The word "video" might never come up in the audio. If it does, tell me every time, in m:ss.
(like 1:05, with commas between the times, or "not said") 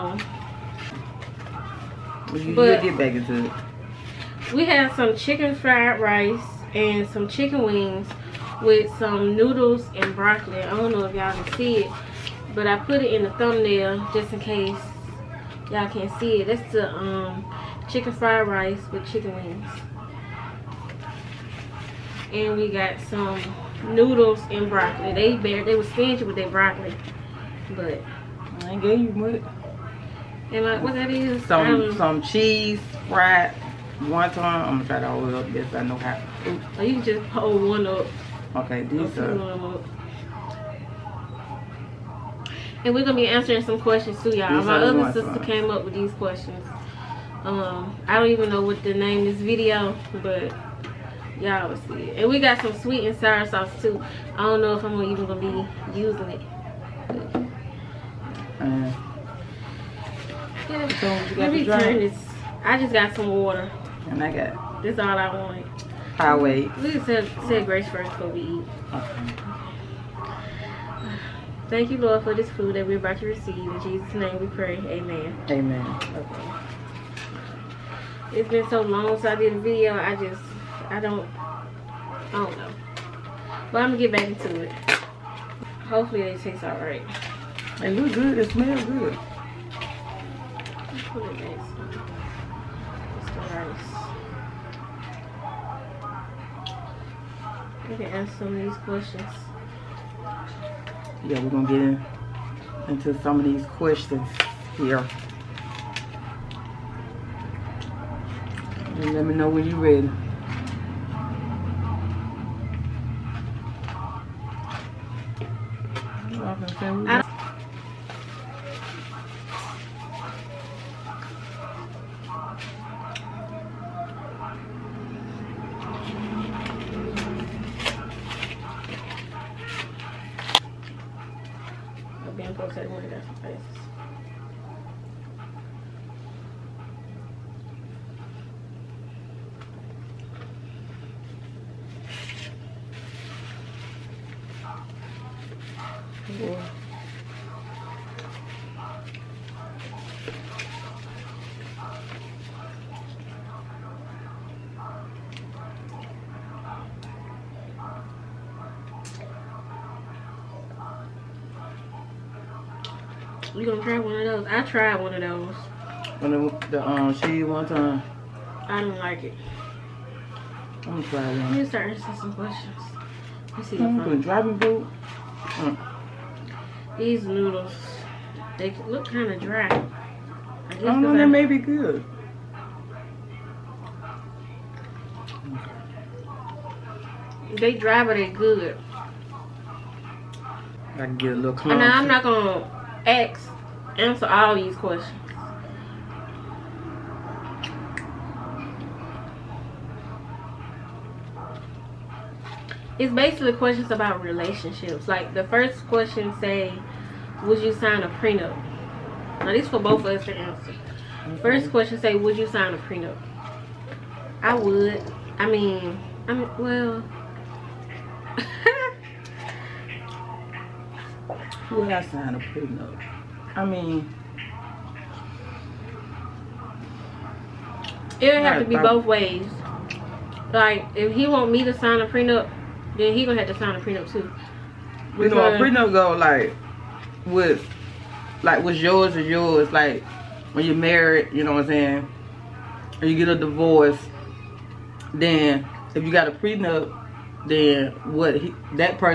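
0:49, 1:19.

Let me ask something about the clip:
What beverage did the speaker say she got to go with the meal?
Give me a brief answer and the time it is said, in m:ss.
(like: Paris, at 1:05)
water, at 1:03.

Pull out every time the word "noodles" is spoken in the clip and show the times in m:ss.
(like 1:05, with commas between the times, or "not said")
0:09, 0:23, 2:57.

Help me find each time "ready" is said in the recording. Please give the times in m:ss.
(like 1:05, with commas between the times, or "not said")
1:49.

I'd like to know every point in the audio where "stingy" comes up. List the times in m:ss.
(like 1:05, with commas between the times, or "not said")
0:25.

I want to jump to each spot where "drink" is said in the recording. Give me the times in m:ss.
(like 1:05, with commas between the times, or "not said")
1:00.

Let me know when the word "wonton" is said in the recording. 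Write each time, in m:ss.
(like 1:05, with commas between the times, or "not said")
0:33, 2:47.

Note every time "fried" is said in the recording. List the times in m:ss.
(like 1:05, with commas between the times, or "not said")
0:05, 0:18, 0:33.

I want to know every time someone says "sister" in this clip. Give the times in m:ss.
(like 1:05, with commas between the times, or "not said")
0:45.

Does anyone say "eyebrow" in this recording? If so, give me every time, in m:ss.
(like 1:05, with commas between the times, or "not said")
not said.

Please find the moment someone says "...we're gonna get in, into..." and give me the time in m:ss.
1:41.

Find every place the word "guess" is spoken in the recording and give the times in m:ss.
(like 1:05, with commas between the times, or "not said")
3:00.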